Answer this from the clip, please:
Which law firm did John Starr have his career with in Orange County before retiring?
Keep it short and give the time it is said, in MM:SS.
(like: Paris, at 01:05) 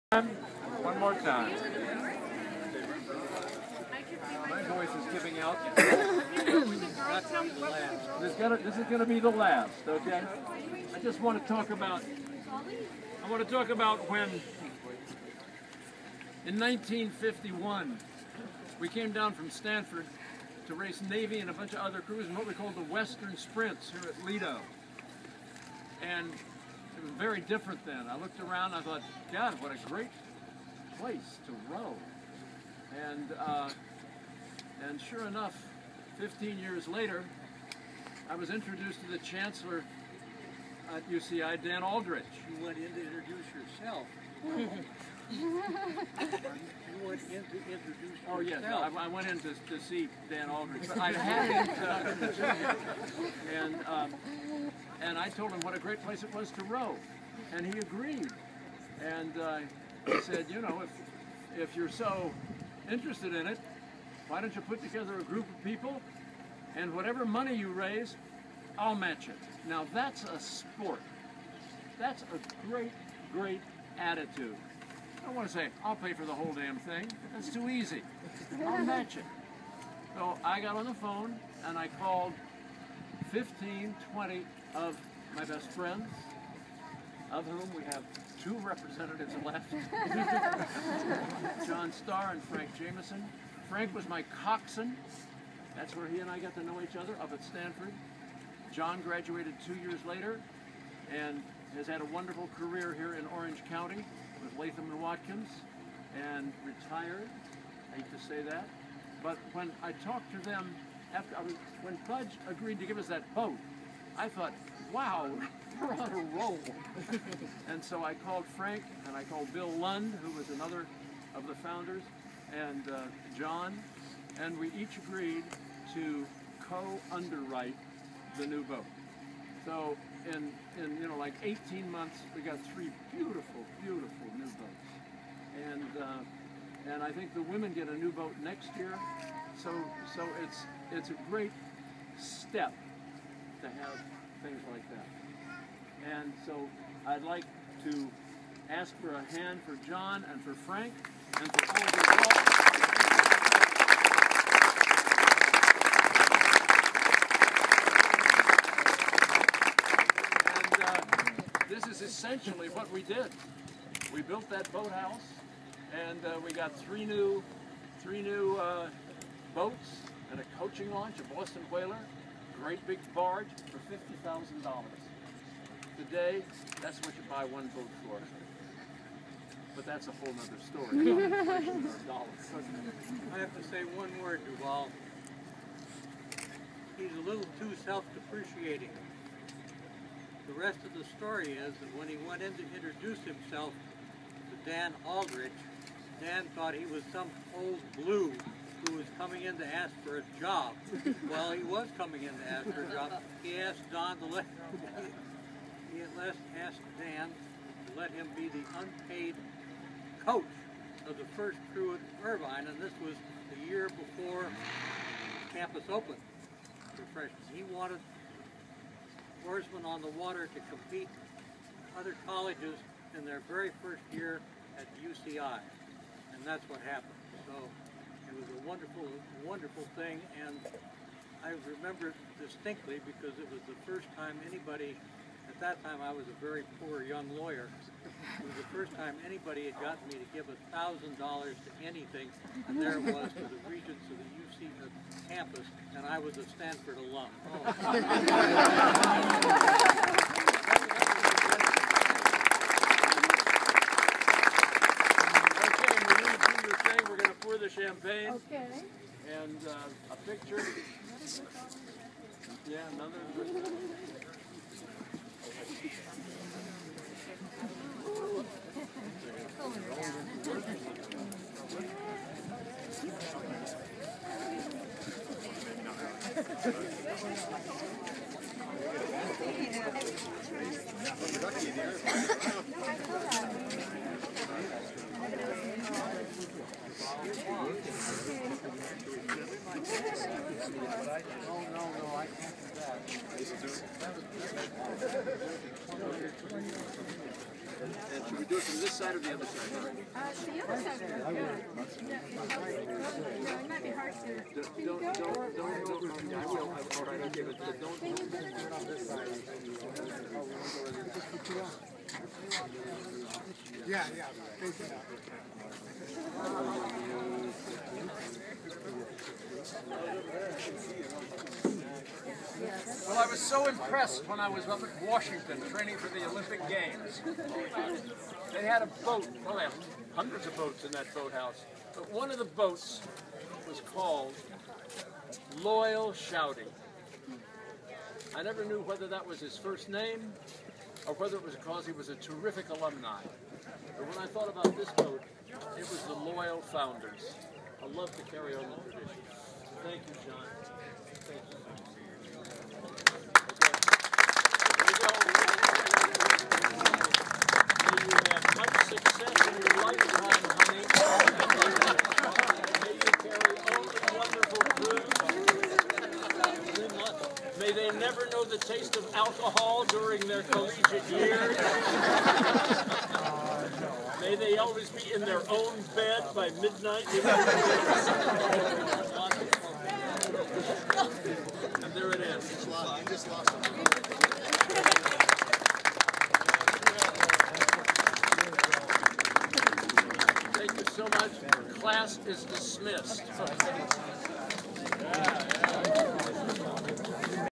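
Latham and Watkins, at 01:44.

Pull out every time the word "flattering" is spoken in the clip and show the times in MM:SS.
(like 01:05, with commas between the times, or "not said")
not said.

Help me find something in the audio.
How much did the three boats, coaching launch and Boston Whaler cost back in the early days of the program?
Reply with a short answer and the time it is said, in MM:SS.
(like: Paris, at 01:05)
$50,000, at 02:53.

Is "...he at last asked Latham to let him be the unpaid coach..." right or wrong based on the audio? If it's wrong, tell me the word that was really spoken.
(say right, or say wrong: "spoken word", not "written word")
wrong: "Dan", not "Latham".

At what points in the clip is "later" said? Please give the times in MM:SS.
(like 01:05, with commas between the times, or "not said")
00:36, 01:40.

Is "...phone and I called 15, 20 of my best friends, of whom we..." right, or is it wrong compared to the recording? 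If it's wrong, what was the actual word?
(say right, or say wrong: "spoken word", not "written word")
right.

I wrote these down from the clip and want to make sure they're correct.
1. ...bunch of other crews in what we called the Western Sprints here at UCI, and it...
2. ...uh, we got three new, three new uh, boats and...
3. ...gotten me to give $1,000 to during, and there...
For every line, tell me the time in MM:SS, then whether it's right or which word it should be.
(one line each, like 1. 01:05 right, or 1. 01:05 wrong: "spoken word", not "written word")
1. 00:21 wrong: "Lido", not "UCI"
2. 02:46 right
3. 03:59 wrong: "anything", not "during".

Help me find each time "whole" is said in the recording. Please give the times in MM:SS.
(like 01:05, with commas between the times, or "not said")
01:16, 03:00.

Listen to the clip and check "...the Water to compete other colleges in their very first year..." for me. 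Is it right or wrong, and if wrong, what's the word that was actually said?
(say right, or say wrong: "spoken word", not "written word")
right.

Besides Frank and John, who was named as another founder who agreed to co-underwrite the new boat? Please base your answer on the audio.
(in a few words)
Bill Lund.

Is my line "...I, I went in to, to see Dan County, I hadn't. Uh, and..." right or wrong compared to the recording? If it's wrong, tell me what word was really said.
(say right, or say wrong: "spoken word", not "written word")
wrong: "Aldrich", not "County".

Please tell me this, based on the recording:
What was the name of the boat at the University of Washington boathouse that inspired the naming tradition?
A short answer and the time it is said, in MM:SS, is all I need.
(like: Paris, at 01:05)
Loyal Shoudy, at 05:35.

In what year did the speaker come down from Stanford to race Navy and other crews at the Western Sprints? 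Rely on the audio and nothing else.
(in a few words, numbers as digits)
1951.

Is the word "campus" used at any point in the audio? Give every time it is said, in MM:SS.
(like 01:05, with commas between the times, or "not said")
03:35, 04:05.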